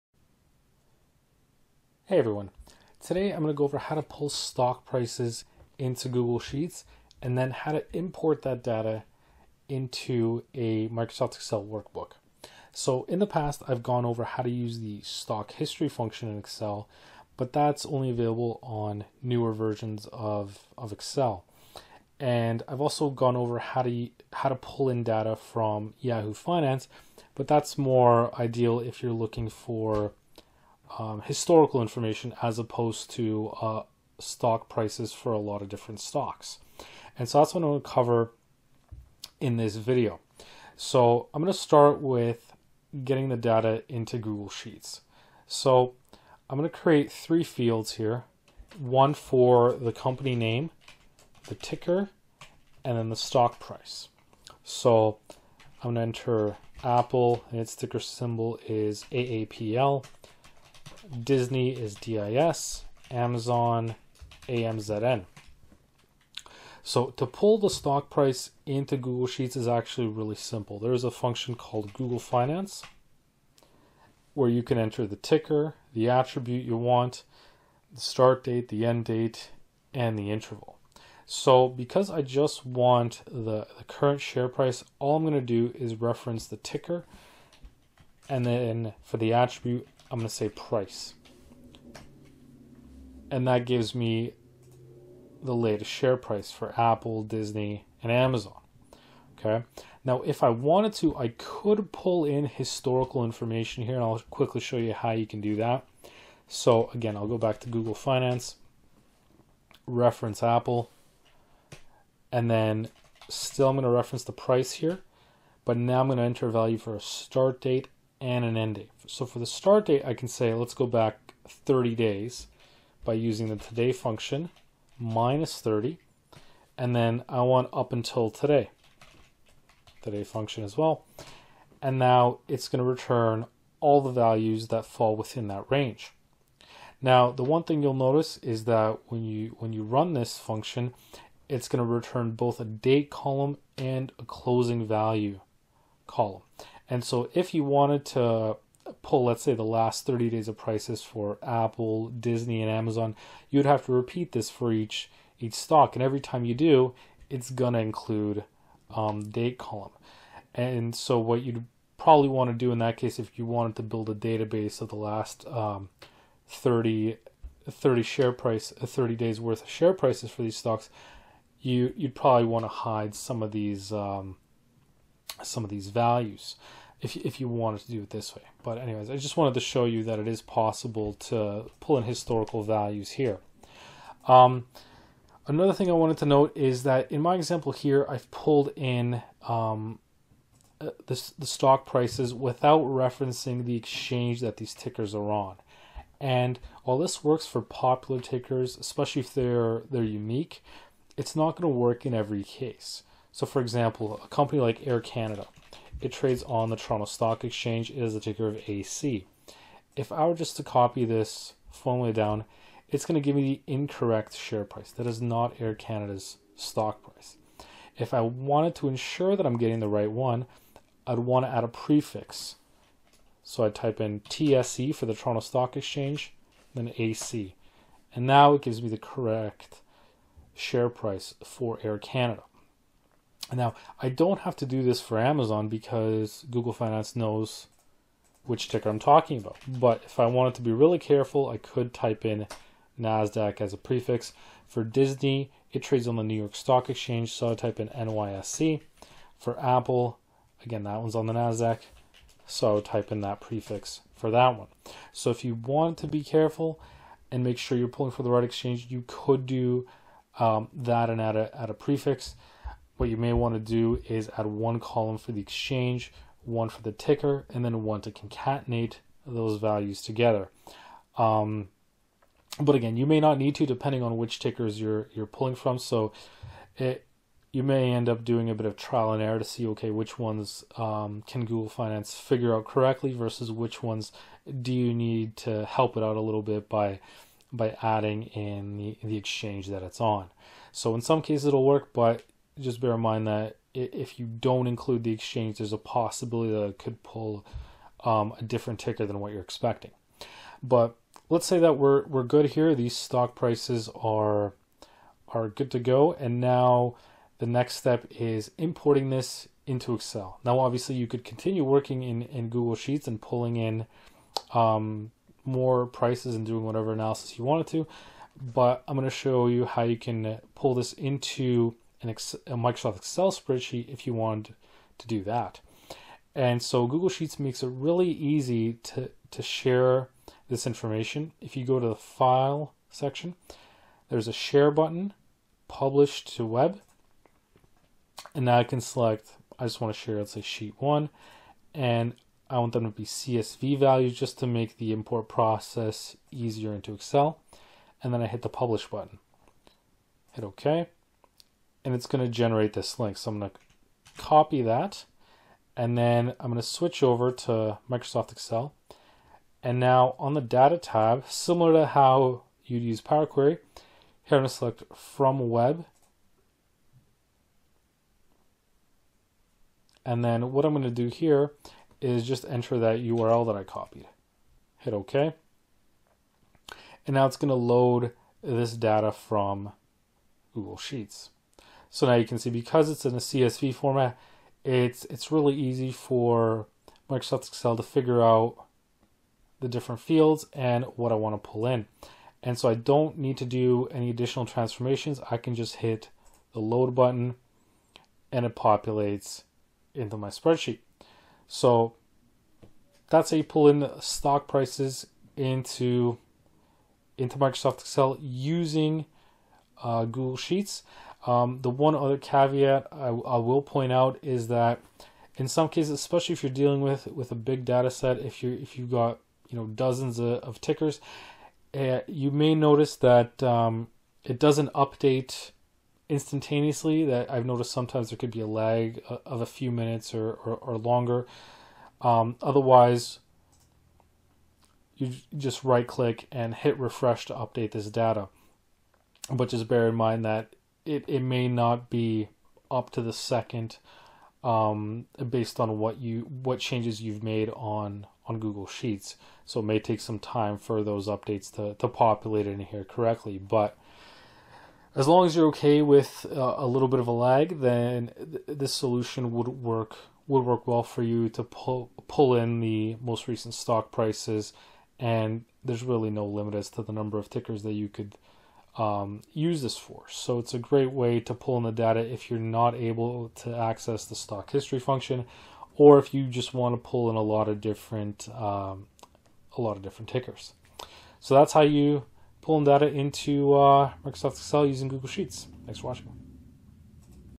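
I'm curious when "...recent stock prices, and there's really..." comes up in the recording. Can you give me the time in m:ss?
7:43.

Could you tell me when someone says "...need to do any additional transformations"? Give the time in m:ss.
6:33.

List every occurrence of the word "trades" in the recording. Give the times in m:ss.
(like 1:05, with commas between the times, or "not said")
3:26, 4:05.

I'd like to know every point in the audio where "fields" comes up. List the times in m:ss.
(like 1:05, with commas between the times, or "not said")
0:47, 6:29.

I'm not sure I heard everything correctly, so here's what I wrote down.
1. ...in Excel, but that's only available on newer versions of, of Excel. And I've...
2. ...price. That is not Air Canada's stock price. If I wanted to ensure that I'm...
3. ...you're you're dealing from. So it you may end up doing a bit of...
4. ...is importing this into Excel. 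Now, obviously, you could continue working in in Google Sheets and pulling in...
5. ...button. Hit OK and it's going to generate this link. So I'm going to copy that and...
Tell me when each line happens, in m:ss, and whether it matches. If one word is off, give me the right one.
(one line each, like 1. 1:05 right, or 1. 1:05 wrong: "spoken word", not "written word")
1. 0:16 right
2. 3:34 right
3. 4:34 wrong: "pulling", not "dealing"
4. 5:08 right
5. 5:48 right.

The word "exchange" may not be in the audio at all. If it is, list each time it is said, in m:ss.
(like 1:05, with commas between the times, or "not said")
3:13, 3:27, 3:45, 4:06, 4:18, 4:25, 4:49, 4:55.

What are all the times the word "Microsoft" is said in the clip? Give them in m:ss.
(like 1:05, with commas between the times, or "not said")
0:10, 5:22, 5:57, 6:27, 6:47, 8:04.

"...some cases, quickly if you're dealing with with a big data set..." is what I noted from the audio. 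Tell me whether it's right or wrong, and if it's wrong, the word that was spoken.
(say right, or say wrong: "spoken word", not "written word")
wrong: "especially", not "quickly".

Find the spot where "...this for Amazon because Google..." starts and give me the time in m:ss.
3:54.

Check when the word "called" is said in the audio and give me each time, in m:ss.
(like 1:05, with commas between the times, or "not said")
1:11.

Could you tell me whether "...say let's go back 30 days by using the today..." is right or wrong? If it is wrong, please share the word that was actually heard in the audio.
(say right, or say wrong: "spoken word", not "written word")
right.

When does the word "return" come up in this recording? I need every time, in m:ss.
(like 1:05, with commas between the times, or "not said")
2:12, 2:21.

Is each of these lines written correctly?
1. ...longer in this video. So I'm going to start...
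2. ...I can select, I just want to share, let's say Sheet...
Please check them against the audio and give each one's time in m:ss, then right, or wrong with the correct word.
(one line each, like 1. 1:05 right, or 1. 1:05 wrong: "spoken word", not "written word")
1. 0:37 wrong: "cover", not "longer"
2. 5:38 right.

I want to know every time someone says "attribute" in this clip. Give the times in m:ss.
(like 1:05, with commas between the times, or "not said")
1:16, 1:29.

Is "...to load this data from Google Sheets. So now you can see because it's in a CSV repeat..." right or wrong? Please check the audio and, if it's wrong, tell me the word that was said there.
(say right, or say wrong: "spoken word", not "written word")
wrong: "format", not "repeat".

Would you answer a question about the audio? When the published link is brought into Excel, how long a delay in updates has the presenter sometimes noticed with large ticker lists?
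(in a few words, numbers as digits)
a few minutes.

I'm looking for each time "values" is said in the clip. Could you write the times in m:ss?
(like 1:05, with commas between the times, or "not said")
1:56, 2:14, 2:24, 2:55, 3:02, 4:29, 5:43.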